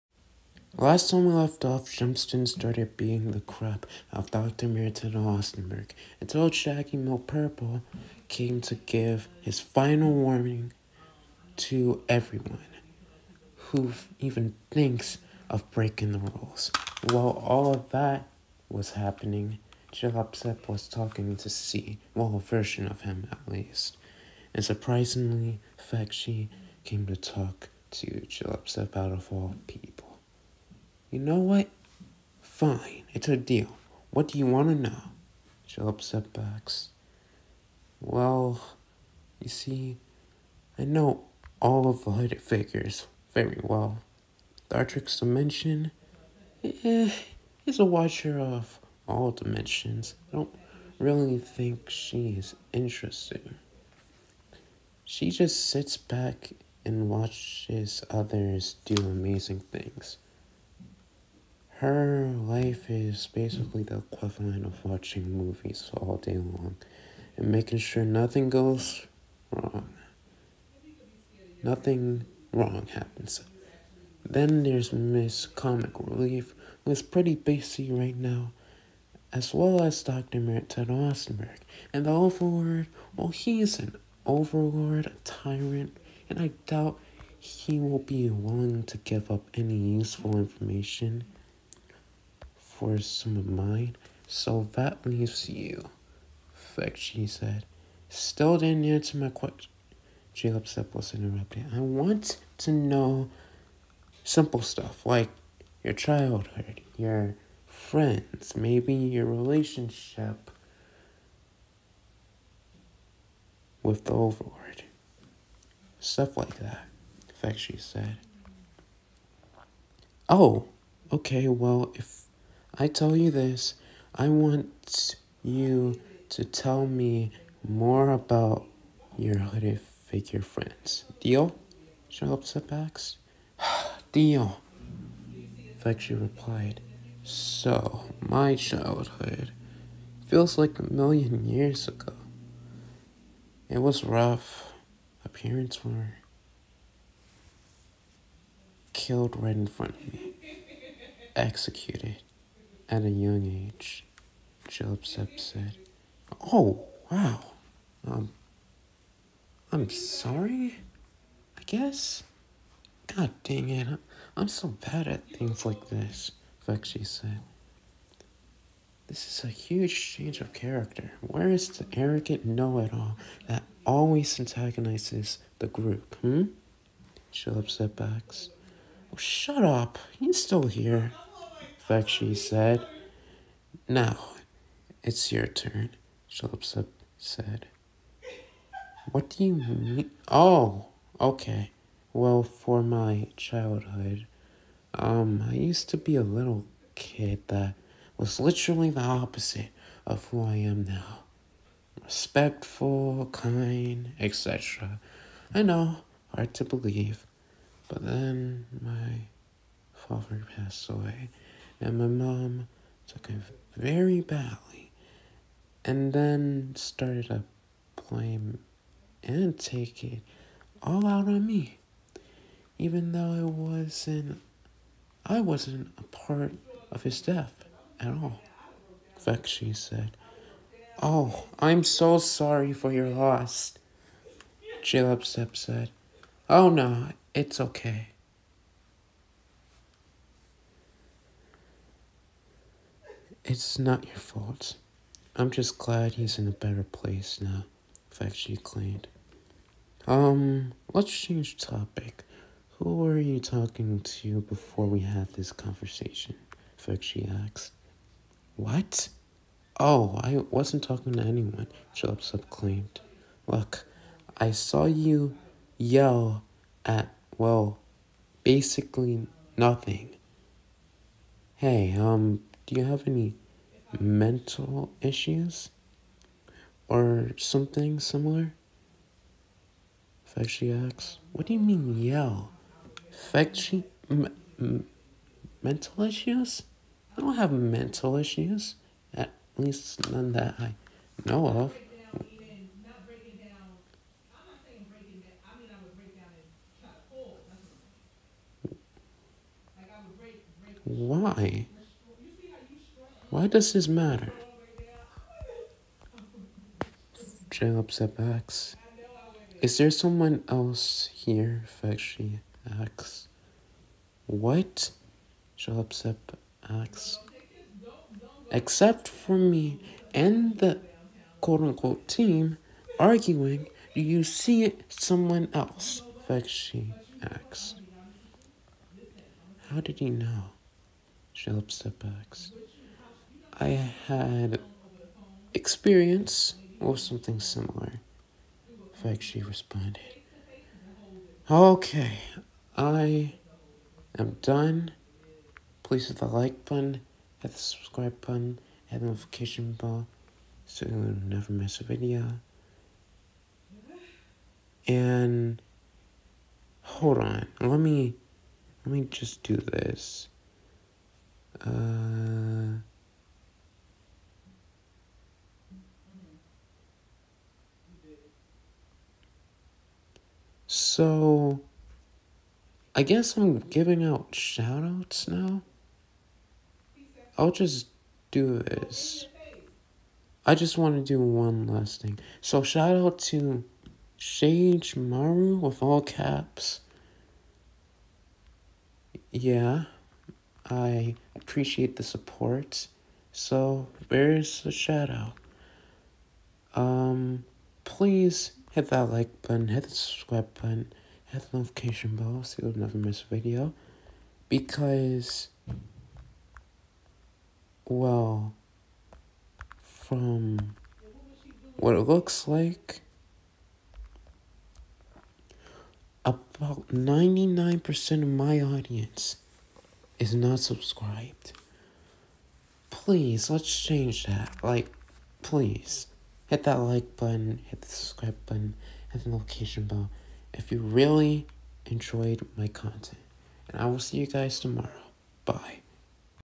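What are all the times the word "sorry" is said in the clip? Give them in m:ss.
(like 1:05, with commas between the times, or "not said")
2:39, 3:52.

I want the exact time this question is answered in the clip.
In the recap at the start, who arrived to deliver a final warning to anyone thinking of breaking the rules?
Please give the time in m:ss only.
0:06.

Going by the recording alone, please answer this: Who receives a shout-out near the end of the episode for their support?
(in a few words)
Sage Maru.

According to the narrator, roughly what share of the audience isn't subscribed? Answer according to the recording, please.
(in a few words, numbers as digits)
99%.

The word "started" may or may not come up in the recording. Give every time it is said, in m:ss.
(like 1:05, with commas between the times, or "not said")
0:02, 3:36.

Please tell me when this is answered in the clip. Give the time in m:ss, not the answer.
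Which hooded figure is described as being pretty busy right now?
1:14.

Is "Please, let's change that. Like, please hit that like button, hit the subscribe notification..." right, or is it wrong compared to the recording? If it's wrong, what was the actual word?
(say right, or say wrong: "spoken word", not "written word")
wrong: "button", not "notification".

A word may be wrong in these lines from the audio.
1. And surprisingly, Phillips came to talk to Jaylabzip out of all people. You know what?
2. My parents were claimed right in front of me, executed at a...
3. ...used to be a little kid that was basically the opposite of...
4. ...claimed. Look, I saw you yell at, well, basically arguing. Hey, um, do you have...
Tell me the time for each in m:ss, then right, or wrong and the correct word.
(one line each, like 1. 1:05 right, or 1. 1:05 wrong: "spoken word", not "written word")
1. 0:24 wrong: "Fakshi", not "Phillips"
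2. 2:25 wrong: "killed", not "claimed"
3. 3:15 wrong: "literally", not "basically"
4. 4:22 wrong: "nothing", not "arguing".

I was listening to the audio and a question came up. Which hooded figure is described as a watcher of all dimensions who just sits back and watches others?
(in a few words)
Dartix Dimension.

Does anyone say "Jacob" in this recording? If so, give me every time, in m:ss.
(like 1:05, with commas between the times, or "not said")
1:40, 5:07, 5:15, 5:31.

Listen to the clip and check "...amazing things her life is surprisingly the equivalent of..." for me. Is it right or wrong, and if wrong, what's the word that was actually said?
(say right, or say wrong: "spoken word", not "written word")
wrong: "basically", not "surprisingly".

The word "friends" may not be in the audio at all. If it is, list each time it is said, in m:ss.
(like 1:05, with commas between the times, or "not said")
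1:47, 2:10.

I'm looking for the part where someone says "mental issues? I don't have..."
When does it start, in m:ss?
4:45.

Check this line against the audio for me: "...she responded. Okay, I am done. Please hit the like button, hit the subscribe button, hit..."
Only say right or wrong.
right.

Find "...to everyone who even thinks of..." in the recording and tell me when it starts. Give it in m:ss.
0:11.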